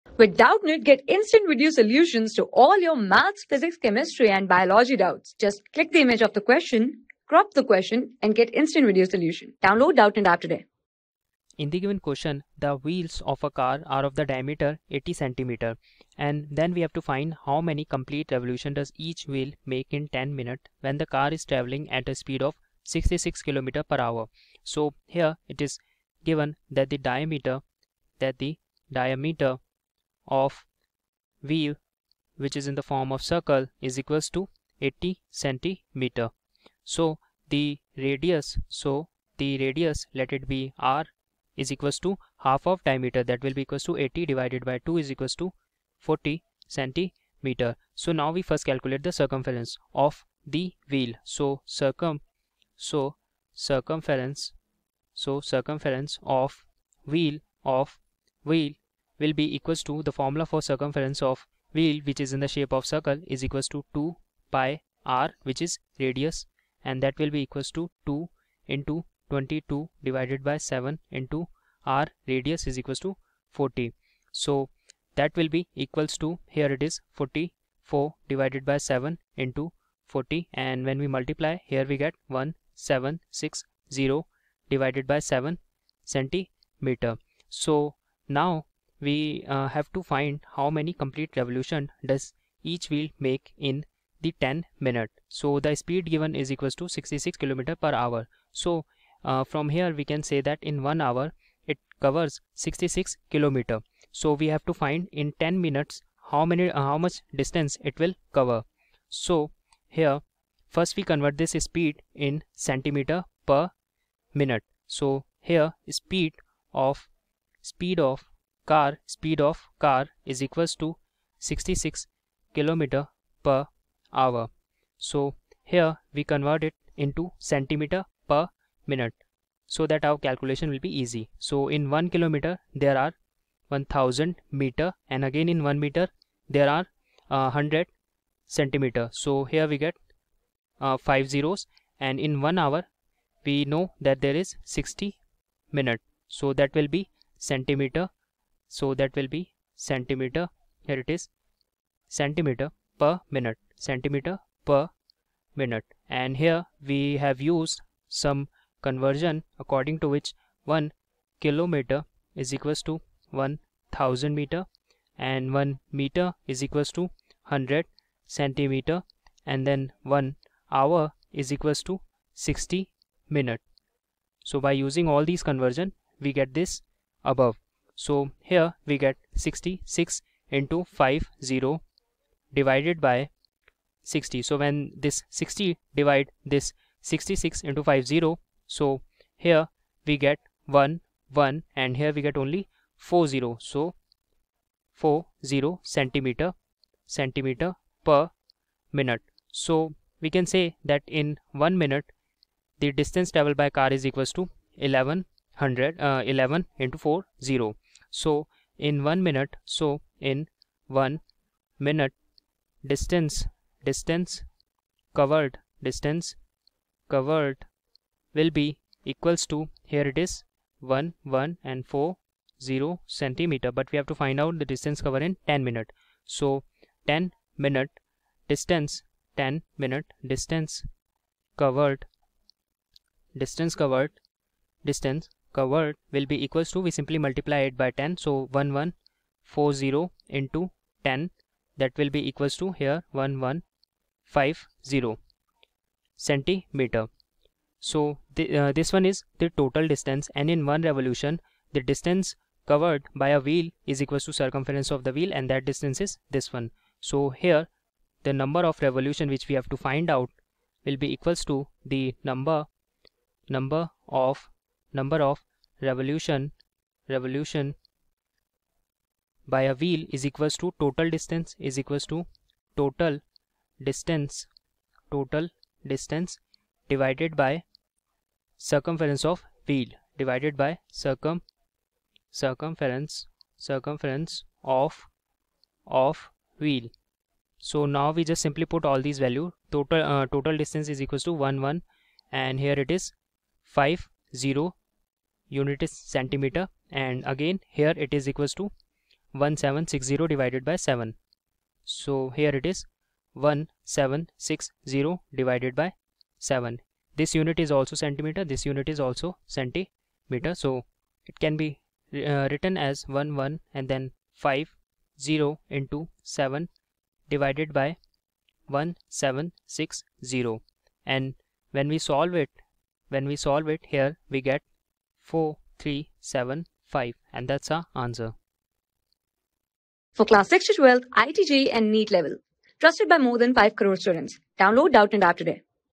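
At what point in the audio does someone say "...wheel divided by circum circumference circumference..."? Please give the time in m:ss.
4:39.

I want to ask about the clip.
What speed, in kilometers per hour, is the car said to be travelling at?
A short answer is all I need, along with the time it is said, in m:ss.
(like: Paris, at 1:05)
66 km per hour, at 0:22.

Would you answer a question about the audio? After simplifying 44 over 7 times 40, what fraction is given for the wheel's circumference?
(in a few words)
1760/7 centimeters.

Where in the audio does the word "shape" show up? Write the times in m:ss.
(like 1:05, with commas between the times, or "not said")
1:02.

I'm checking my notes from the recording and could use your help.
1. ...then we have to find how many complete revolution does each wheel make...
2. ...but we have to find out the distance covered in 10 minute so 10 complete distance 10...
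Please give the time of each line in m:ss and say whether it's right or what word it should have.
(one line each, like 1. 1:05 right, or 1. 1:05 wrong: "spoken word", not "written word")
1. 0:16 right
2. 3:43 wrong: "minute", not "complete".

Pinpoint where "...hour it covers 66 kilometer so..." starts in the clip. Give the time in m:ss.
1:41.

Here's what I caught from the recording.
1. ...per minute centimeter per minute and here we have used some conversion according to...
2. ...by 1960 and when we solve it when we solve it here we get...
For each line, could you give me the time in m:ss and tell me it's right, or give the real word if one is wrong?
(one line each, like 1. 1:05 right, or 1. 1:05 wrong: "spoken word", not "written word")
1. 2:33 right
2. 5:17 wrong: "1760", not "1960".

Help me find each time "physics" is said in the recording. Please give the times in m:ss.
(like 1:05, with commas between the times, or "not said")
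0:03.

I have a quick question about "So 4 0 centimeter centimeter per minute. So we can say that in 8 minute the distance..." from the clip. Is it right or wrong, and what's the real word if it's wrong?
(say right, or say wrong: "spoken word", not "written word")
wrong: "1", not "8".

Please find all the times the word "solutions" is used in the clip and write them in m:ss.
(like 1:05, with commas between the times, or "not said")
0:01, 0:09.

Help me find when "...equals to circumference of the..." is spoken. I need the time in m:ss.
4:14.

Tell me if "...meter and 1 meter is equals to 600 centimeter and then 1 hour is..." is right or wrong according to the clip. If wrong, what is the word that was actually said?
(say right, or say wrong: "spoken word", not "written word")
wrong: "100", not "600".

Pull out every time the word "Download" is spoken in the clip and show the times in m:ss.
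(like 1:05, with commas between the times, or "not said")
0:09, 5:34.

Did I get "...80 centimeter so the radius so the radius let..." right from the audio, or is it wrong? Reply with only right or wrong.
right.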